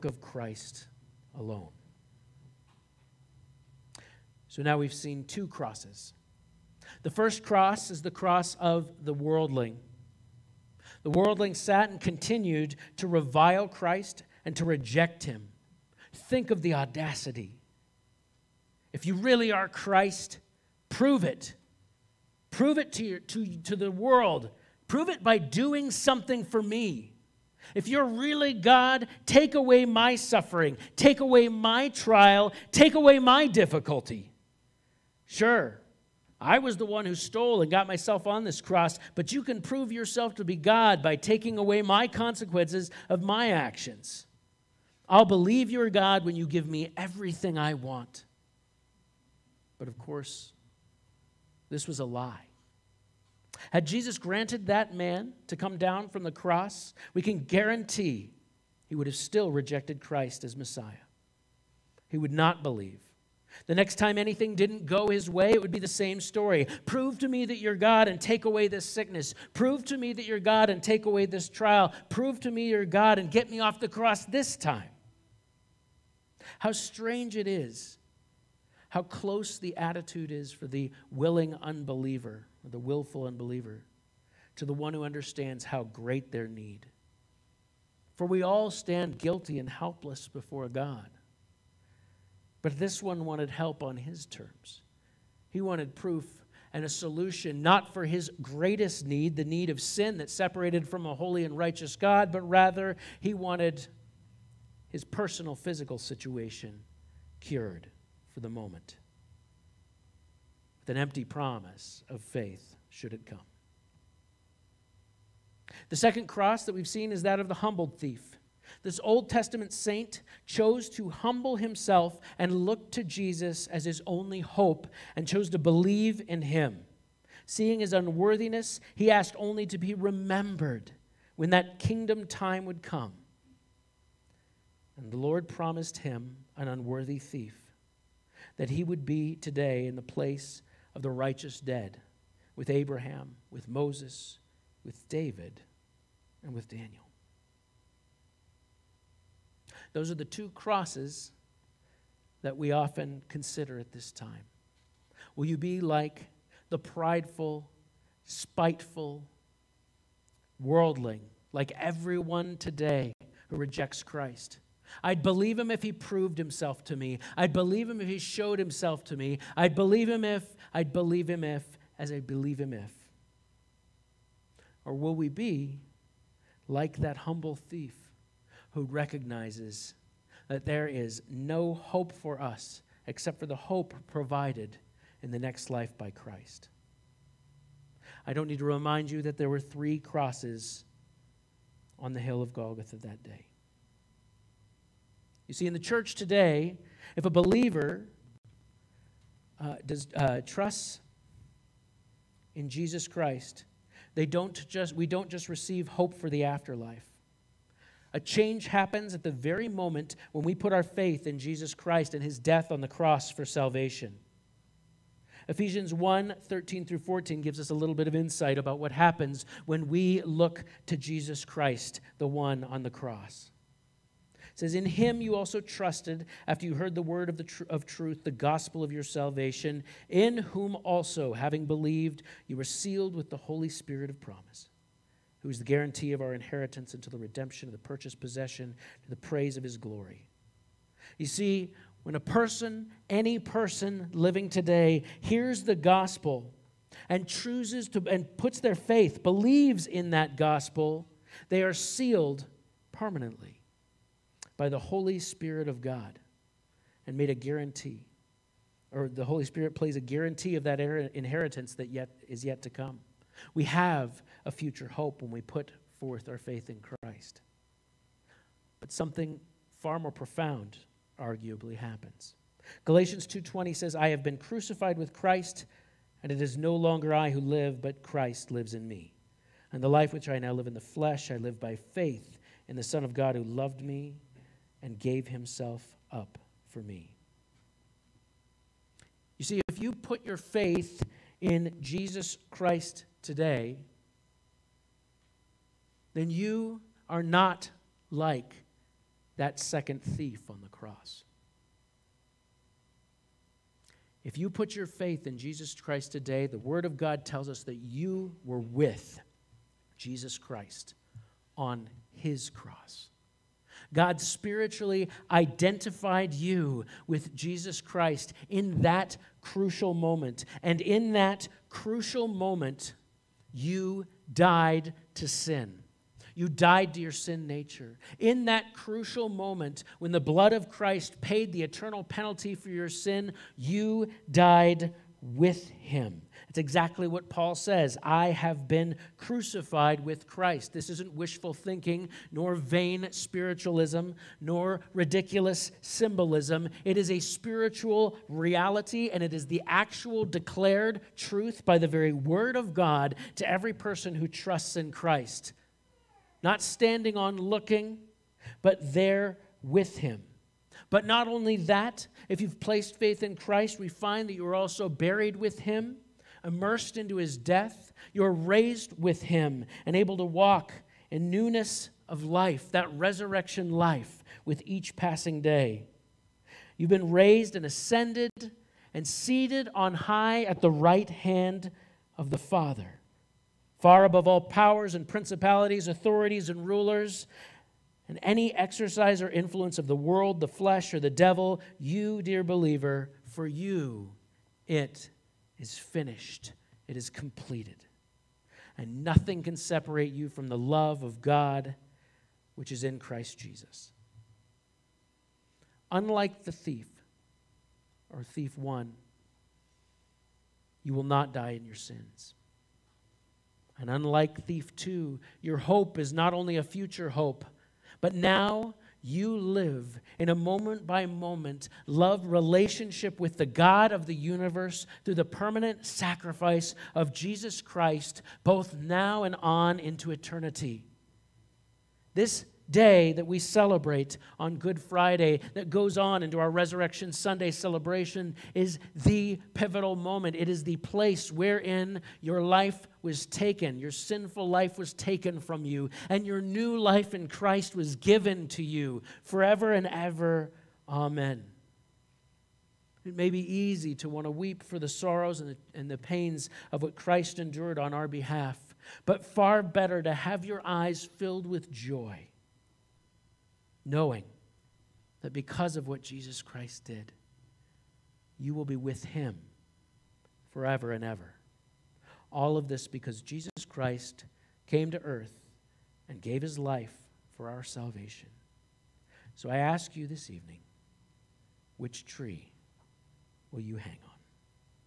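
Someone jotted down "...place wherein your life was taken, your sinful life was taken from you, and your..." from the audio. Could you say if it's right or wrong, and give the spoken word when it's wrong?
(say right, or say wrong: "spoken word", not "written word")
right.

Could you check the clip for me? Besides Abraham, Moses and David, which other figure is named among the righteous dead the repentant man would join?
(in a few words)
Daniel.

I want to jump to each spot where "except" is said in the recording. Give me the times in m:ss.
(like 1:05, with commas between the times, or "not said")
3:03.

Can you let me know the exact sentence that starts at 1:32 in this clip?
But this one wanted help on his terms.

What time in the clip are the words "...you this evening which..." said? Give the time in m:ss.
7:59.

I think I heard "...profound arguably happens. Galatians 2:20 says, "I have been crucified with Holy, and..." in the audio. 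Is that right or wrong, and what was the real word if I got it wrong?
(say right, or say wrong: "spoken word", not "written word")
wrong: "Christ", not "Holy".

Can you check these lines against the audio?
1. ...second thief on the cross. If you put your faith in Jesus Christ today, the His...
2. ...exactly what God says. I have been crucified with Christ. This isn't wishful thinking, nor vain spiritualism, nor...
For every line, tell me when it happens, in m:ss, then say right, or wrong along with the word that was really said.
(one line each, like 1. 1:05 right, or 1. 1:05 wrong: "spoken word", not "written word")
1. 4:59 wrong: "Word", not "His"
2. 5:36 wrong: "Paul", not "God".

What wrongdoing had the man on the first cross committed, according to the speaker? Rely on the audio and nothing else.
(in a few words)
stole.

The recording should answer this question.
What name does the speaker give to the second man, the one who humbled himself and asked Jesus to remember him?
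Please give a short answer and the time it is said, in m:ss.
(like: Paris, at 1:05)
the humbled thief, at 1:57.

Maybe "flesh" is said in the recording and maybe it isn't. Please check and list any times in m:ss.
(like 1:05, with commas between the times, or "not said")
4:40, 6:30.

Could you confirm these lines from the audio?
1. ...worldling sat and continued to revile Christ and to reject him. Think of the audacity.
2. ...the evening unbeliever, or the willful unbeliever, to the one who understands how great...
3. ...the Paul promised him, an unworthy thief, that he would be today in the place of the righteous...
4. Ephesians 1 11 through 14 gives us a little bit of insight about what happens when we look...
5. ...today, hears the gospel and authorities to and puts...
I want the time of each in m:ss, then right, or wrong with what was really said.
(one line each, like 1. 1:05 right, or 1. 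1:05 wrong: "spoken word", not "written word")
1. 0:11 right
2. 1:20 wrong: "willing", not "evening"
3. 2:15 wrong: "Lord", not "Paul"
4. 3:35 wrong: "13", not "11"
5. 4:04 wrong: "chooses", not "authorities".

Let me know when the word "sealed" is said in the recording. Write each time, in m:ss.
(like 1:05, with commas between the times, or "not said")
3:52, 4:11.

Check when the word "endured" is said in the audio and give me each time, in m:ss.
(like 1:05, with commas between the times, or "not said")
7:37.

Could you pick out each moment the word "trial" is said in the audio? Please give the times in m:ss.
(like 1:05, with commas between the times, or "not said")
0:31, 1:11.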